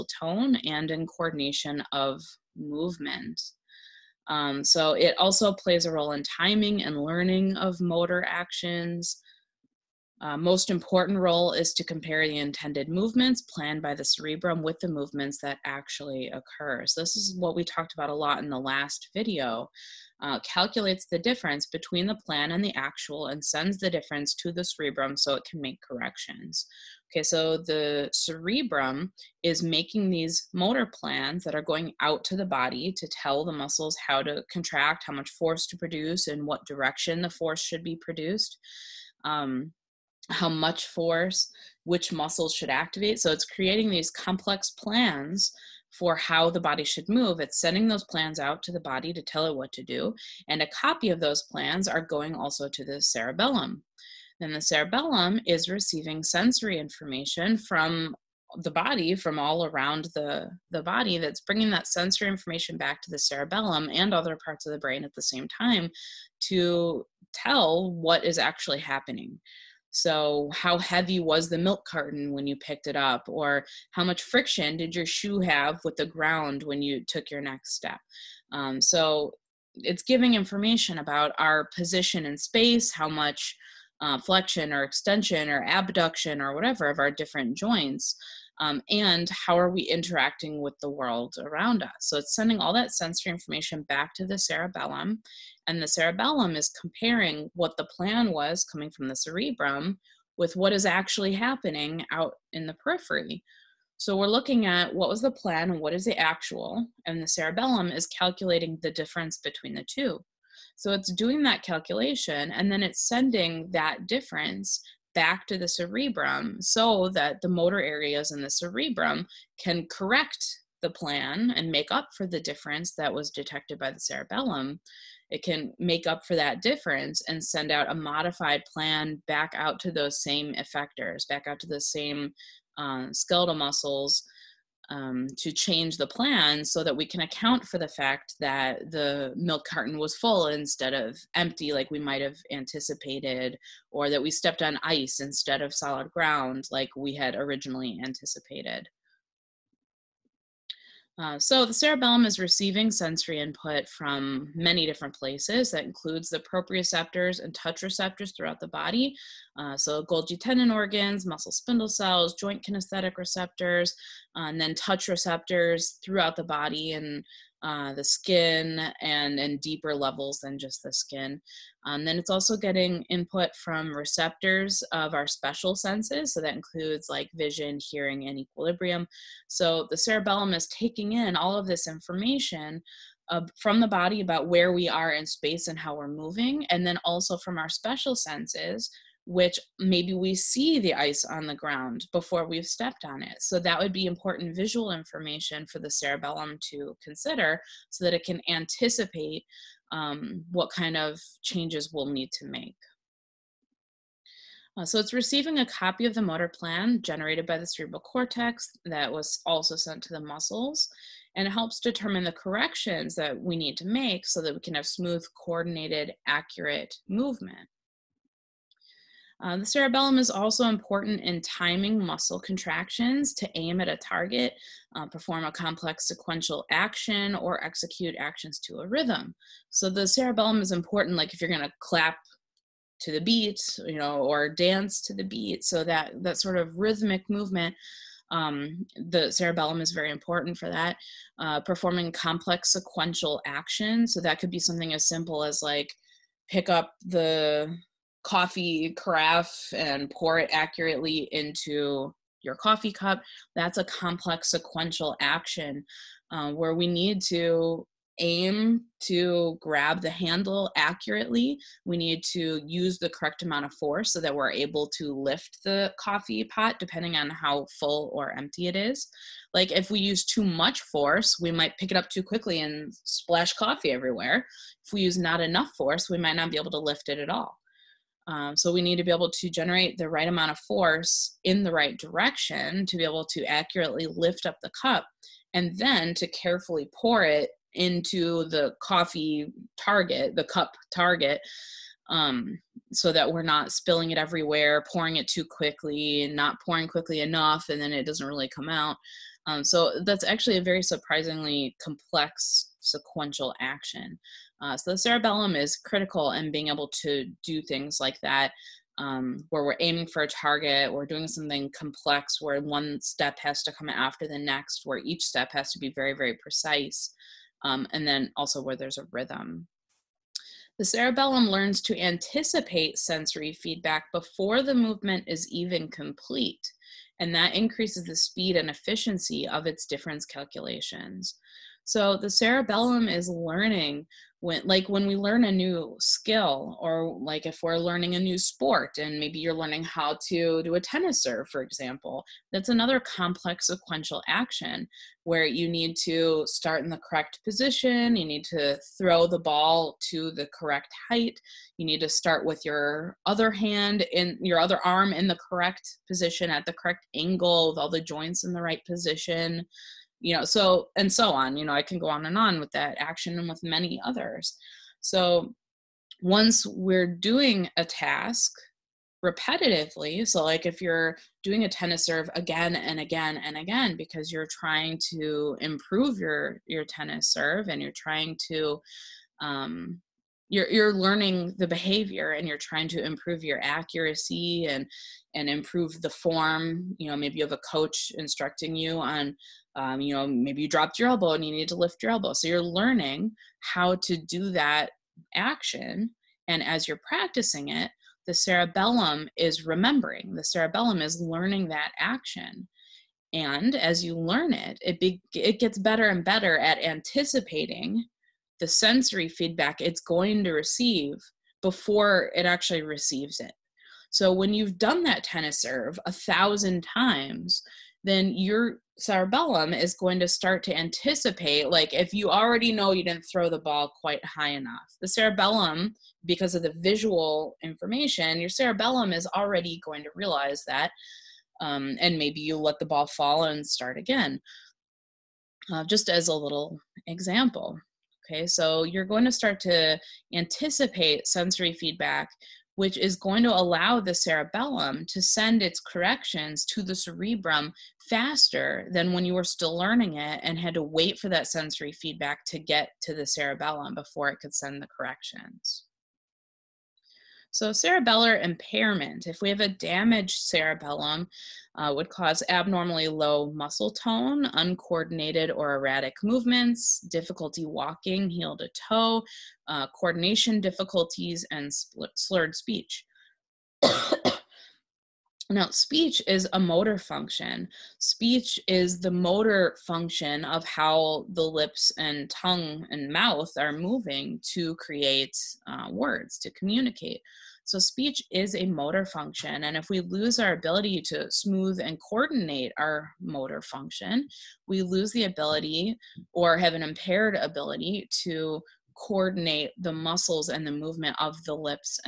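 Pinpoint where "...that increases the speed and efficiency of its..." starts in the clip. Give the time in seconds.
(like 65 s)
327 s.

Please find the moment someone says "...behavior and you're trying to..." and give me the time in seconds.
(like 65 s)
381 s.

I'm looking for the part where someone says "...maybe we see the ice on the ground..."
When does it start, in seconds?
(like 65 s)
189 s.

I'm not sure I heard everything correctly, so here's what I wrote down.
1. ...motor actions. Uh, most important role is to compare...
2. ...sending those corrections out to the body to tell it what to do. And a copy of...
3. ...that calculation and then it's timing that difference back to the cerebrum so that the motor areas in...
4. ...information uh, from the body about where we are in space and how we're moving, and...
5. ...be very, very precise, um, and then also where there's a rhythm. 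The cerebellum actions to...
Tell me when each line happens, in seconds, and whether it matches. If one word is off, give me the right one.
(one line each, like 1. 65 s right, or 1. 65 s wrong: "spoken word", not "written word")
1. 7 s right
2. 47 s wrong: "plans", not "corrections"
3. 111 s wrong: "sending", not "timing"
4. 181 s right
5. 315 s wrong: "learns", not "actions".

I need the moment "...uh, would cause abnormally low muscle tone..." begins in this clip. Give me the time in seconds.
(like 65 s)
461 s.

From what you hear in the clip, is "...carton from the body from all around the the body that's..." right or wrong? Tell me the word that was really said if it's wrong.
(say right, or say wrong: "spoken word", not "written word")
wrong: "information", not "carton".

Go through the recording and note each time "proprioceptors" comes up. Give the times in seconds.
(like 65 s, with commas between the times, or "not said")
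156 s.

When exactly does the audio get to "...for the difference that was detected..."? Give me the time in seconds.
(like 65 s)
122 s.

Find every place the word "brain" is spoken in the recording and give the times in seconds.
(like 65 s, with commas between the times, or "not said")
64 s.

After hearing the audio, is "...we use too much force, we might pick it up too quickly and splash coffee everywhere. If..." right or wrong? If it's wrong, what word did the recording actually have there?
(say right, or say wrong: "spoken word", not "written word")
right.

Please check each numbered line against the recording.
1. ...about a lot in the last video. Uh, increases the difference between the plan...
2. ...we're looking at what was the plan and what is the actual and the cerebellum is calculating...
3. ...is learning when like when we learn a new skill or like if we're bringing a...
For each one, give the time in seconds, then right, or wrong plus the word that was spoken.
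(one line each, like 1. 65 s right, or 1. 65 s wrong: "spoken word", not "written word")
1. 17 s wrong: "calculates", not "increases"
2. 104 s right
3. 333 s wrong: "learning", not "bringing".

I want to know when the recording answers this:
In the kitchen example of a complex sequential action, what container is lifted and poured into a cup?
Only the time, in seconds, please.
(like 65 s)
248 s.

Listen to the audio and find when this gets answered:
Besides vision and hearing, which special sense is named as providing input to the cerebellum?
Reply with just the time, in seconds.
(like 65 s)
178 s.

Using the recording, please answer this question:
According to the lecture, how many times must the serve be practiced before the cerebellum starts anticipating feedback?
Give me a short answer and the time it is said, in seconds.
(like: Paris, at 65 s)
1000, at 416 s.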